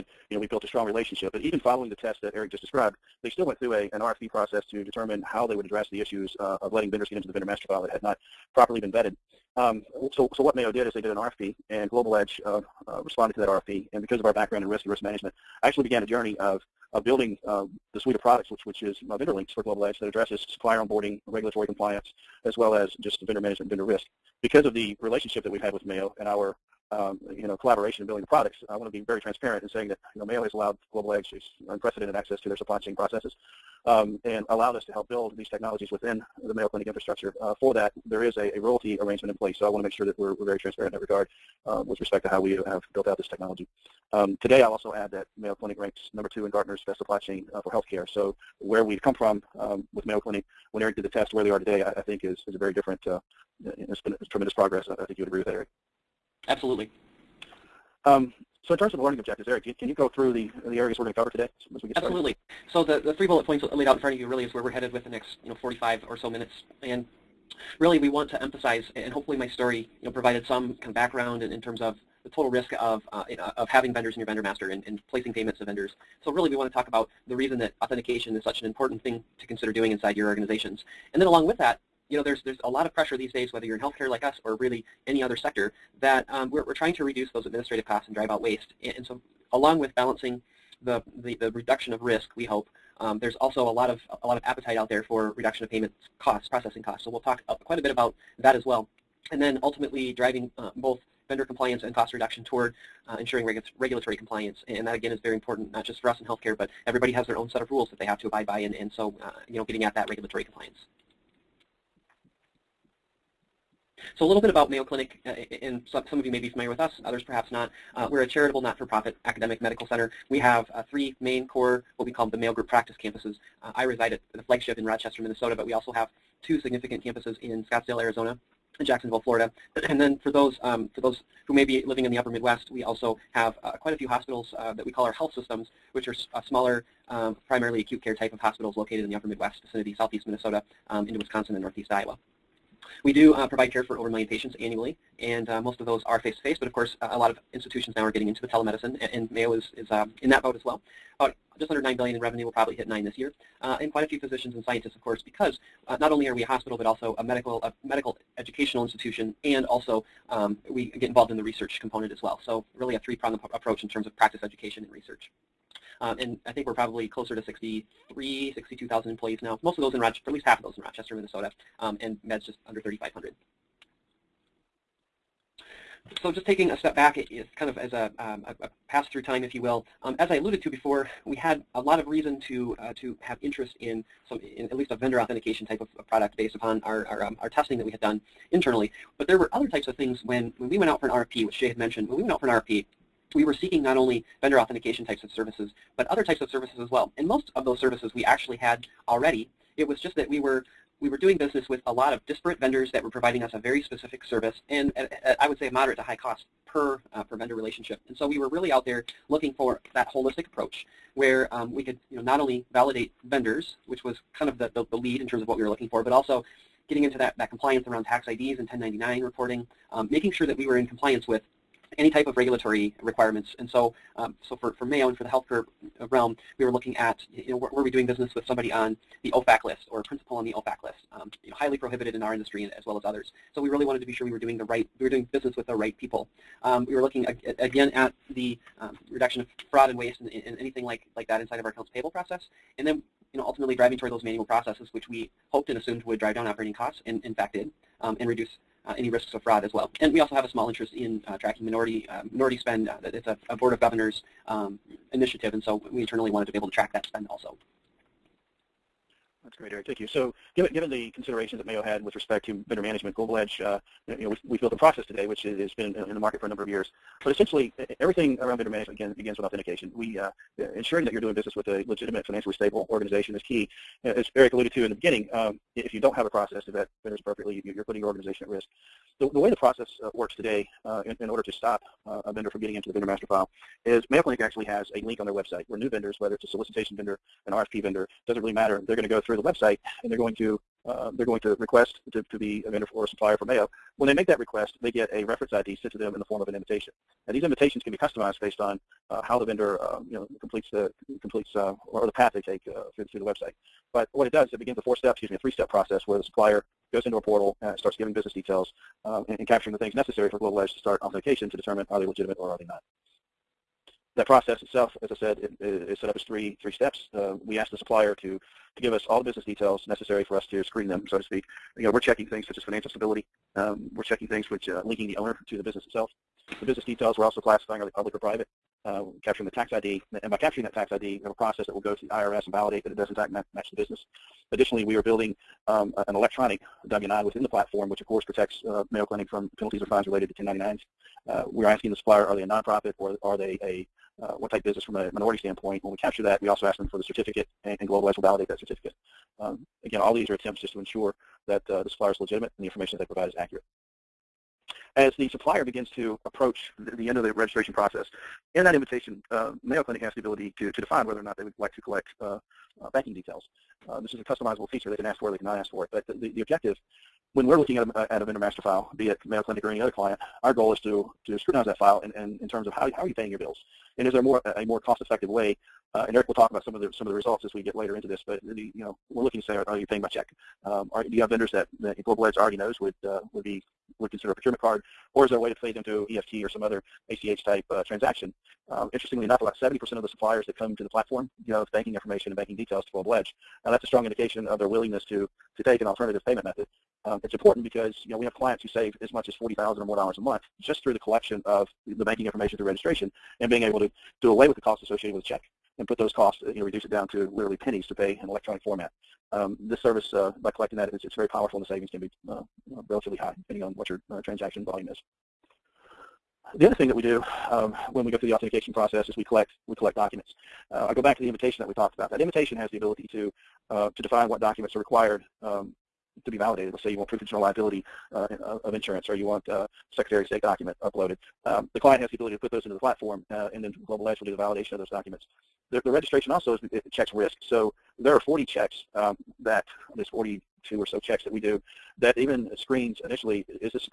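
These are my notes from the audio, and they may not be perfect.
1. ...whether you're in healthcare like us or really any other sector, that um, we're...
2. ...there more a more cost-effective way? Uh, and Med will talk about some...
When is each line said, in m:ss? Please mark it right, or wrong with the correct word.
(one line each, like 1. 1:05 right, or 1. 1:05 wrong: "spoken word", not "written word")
1. 1:23 right
2. 6:14 wrong: "Eric", not "Med".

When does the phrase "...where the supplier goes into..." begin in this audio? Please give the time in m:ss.
5:06.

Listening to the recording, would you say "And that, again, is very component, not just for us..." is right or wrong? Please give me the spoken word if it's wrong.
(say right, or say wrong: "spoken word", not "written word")
wrong: "important", not "component".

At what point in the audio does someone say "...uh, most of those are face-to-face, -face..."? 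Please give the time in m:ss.
2:25.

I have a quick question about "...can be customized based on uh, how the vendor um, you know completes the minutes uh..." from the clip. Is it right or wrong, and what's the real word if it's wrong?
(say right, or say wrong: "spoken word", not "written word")
wrong: "completes", not "minutes".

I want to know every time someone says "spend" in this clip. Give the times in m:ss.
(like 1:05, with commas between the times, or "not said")
4:12, 4:17.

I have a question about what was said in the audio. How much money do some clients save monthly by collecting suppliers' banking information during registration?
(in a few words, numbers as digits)
$40,000.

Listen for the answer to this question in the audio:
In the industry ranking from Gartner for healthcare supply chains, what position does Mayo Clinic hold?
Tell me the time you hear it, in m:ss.
0:46.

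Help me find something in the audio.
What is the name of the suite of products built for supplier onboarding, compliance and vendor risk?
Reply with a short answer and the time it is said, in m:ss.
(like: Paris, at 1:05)
VendorLynx, at 0:19.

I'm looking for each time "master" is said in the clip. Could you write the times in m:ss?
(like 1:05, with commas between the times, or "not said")
0:07, 1:14, 4:43, 6:08.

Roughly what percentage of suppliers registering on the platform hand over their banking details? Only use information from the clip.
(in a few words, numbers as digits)
70%.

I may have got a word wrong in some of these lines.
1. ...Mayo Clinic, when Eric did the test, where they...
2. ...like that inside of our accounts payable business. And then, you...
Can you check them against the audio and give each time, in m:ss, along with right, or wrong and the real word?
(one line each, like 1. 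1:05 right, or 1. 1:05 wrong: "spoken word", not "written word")
1. 0:50 right
2. 4:01 wrong: "process", not "business".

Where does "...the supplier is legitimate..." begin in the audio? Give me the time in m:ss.
5:51.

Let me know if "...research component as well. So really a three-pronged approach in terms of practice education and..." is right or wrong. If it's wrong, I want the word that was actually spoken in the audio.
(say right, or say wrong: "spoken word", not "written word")
right.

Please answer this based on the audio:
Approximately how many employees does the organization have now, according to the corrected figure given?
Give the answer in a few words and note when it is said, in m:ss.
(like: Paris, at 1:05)
62,000, at 2:49.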